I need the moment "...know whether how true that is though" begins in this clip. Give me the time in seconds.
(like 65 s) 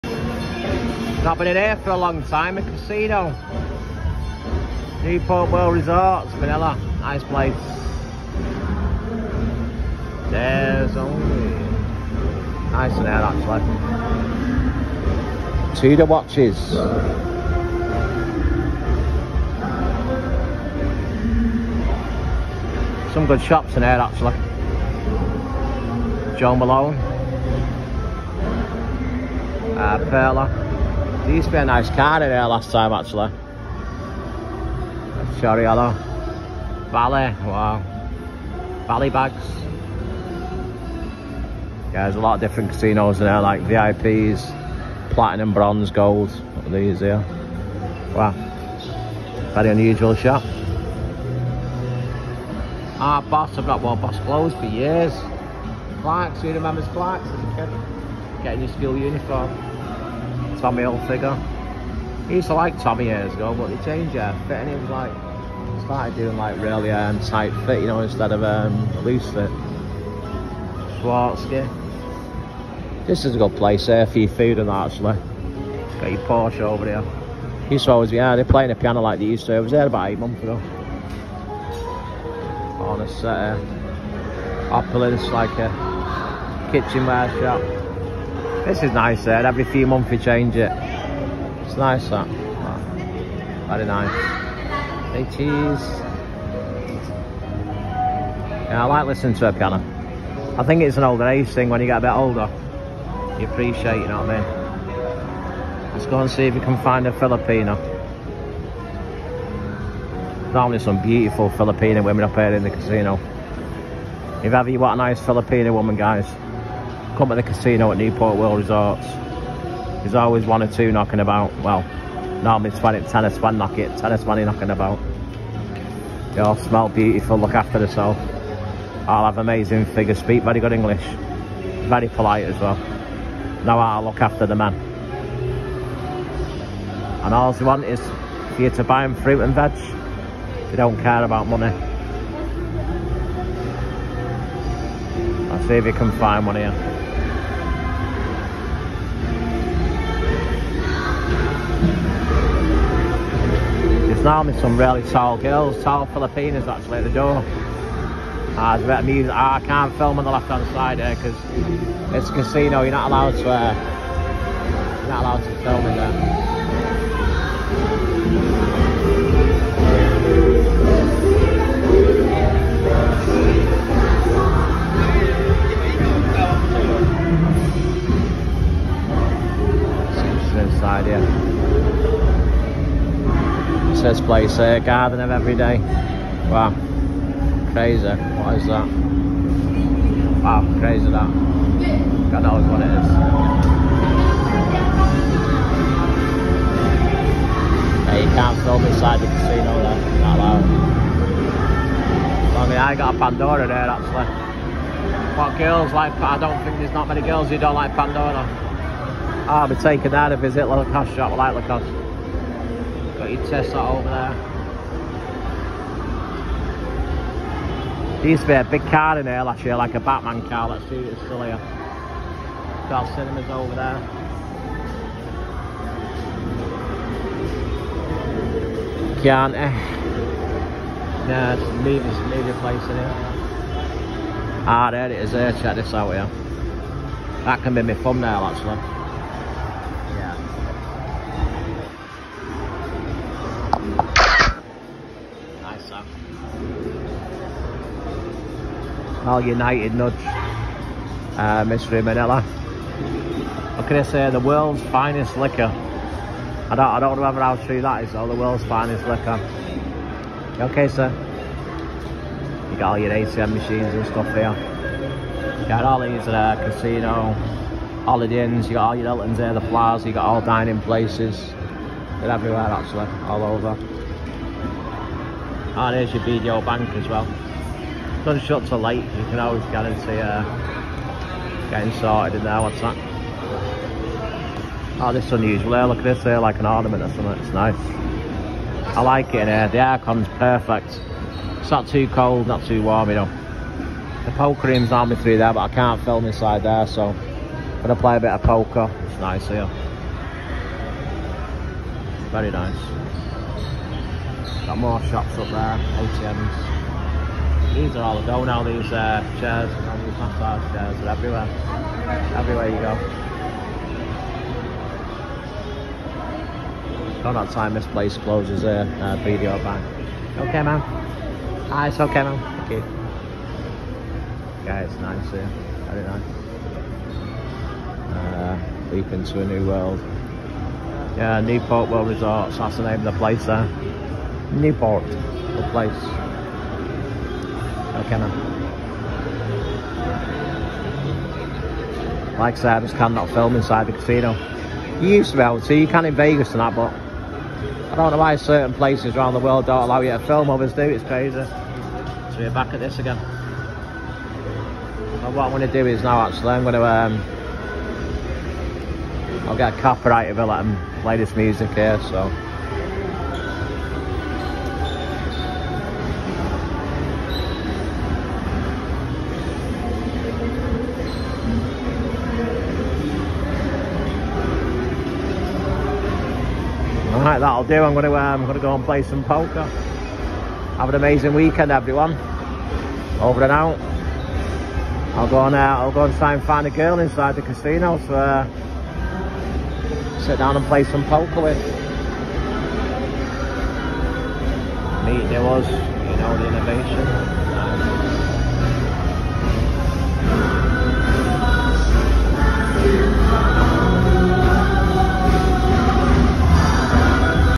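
257 s.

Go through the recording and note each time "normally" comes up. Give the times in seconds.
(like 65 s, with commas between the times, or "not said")
110 s, 122 s.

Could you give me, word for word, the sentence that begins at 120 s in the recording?
There's always one or two knocking about.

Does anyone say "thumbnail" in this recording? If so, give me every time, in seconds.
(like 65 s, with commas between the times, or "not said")
237 s.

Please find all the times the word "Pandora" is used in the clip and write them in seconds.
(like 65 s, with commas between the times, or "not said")
203 s, 207 s.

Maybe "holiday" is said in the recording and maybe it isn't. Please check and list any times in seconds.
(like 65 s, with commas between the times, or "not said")
268 s.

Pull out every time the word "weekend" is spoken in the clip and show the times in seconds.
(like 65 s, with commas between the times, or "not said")
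381 s.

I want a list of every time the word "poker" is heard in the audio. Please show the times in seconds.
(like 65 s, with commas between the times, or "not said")
294 s, 298 s, 379 s, 391 s.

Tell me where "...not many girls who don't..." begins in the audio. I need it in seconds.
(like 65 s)
206 s.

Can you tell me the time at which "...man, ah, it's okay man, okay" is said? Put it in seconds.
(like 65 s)
320 s.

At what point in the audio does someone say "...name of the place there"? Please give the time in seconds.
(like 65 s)
332 s.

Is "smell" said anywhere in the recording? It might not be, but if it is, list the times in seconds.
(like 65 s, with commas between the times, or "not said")
126 s.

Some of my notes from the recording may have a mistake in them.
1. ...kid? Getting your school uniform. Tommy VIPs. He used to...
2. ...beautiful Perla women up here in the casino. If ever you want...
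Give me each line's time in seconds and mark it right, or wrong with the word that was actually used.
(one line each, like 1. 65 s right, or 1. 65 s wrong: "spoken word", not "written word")
1. 57 s wrong: "Hilfiger", not "VIPs"
2. 111 s wrong: "Filipino", not "Perla".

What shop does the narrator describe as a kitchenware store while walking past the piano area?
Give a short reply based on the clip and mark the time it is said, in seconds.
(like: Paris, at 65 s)
Opulence, at 84 s.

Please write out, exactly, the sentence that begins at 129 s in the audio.
All have amazing figures, speak very good English.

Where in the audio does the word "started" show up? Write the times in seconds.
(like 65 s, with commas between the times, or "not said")
65 s.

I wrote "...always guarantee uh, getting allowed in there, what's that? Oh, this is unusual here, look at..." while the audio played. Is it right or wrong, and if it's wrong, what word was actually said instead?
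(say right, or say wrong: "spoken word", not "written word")
wrong: "sorted", not "allowed".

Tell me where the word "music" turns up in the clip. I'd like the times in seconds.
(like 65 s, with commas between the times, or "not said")
159 s, 361 s.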